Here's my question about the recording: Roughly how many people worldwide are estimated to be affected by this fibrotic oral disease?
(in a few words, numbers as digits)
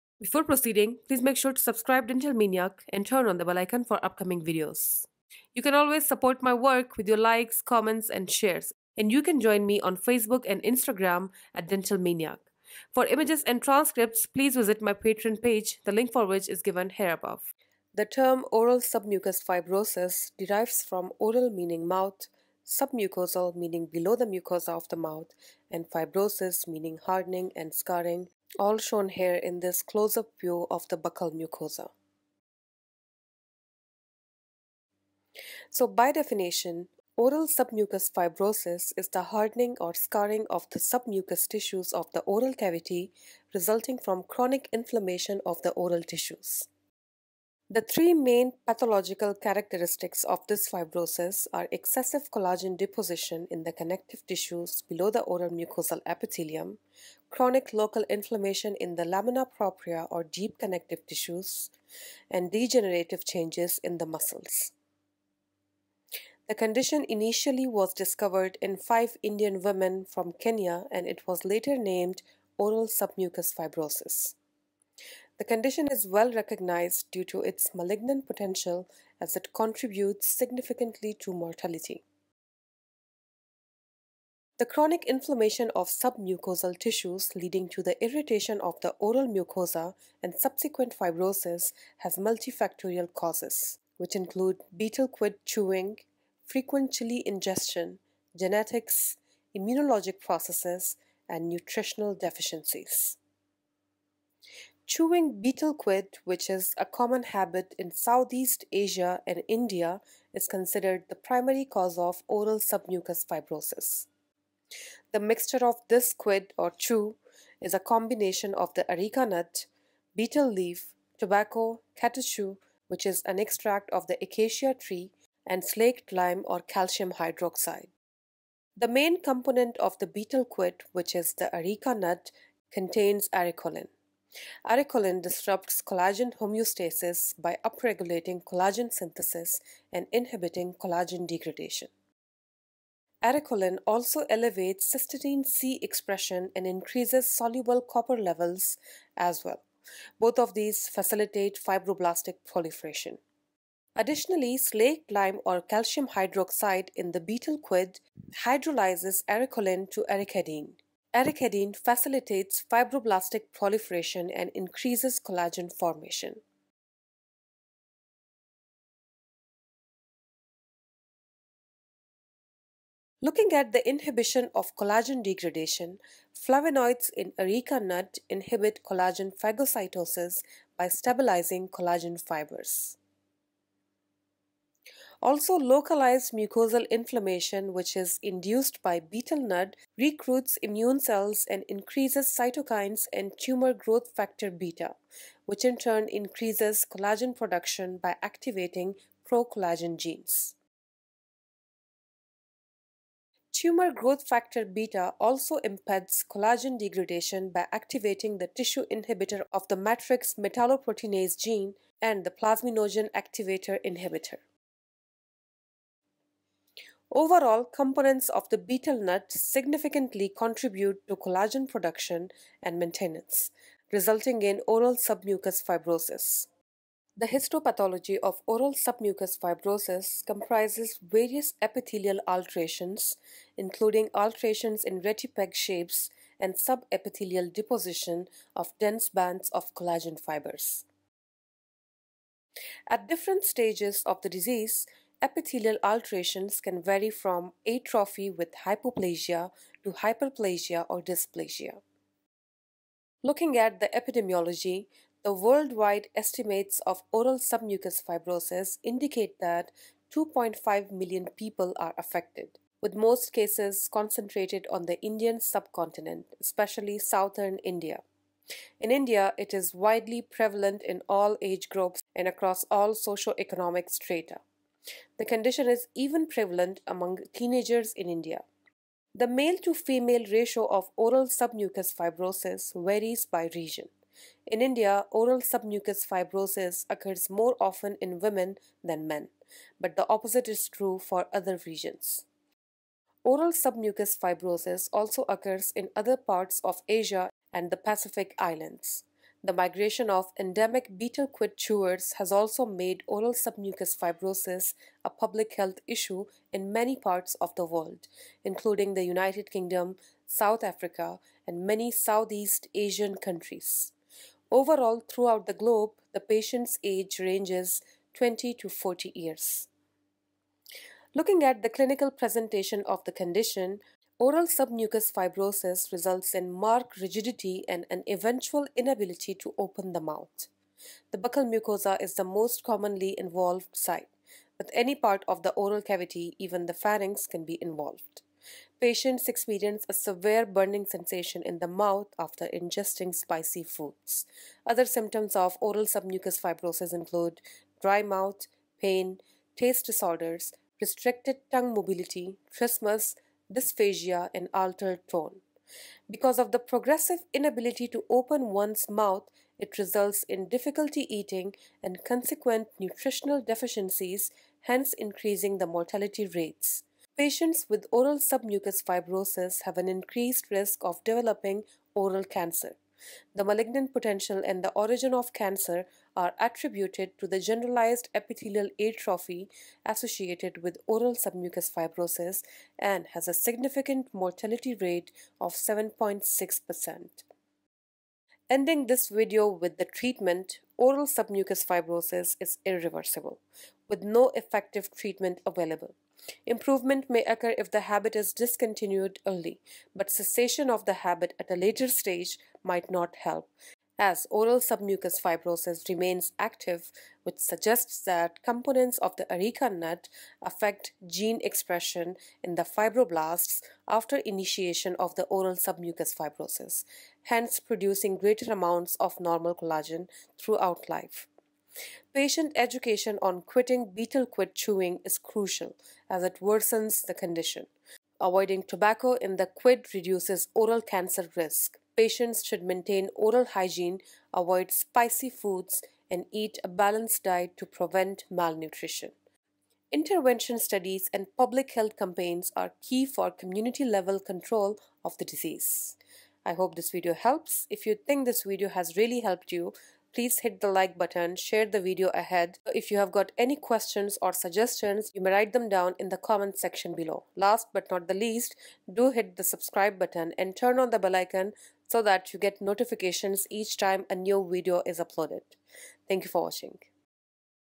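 2.5 million.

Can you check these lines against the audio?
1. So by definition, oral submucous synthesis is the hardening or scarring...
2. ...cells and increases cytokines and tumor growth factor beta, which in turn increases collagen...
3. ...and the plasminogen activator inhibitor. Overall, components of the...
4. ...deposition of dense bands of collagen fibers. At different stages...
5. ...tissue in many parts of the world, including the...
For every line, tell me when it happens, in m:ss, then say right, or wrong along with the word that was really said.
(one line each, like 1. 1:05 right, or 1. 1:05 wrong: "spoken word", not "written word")
1. 0:35 wrong: "fibrosis", not "synthesis"
2. 3:10 right
3. 3:32 right
4. 3:57 right
5. 5:05 wrong: "issue", not "tissue".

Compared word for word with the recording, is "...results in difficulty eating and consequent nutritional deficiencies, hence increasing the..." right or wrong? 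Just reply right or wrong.
right.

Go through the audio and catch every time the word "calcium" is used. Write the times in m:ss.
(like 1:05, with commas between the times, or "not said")
2:06, 2:35.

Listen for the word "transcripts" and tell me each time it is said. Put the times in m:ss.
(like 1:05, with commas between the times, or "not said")
0:13.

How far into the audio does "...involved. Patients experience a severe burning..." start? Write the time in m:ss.
5:37.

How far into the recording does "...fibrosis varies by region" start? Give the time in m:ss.
4:41.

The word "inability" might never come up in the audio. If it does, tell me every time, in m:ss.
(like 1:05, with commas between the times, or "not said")
5:28, 5:57.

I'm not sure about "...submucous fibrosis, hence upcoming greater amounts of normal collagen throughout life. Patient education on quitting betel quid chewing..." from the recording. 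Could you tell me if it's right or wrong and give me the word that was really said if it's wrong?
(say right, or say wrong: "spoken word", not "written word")
wrong: "producing", not "upcoming".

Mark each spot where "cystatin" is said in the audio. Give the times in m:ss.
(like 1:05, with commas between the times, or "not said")
2:24.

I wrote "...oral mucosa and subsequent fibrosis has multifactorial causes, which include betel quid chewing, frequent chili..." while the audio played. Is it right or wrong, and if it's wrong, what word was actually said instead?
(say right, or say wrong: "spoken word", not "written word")
right.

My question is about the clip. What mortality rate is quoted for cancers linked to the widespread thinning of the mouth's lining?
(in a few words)
7.6%.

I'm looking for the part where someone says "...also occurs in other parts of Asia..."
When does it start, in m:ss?
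4:54.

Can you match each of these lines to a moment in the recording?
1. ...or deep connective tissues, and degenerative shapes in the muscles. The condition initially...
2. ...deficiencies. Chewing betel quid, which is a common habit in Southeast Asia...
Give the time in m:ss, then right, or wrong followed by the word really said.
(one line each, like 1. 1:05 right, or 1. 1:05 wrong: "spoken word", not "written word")
1. 1:00 wrong: "changes", not "shapes"
2. 1:42 right.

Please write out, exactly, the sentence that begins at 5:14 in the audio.
Overall, throughout the globe, the patient's age ranges 20 to 40 years.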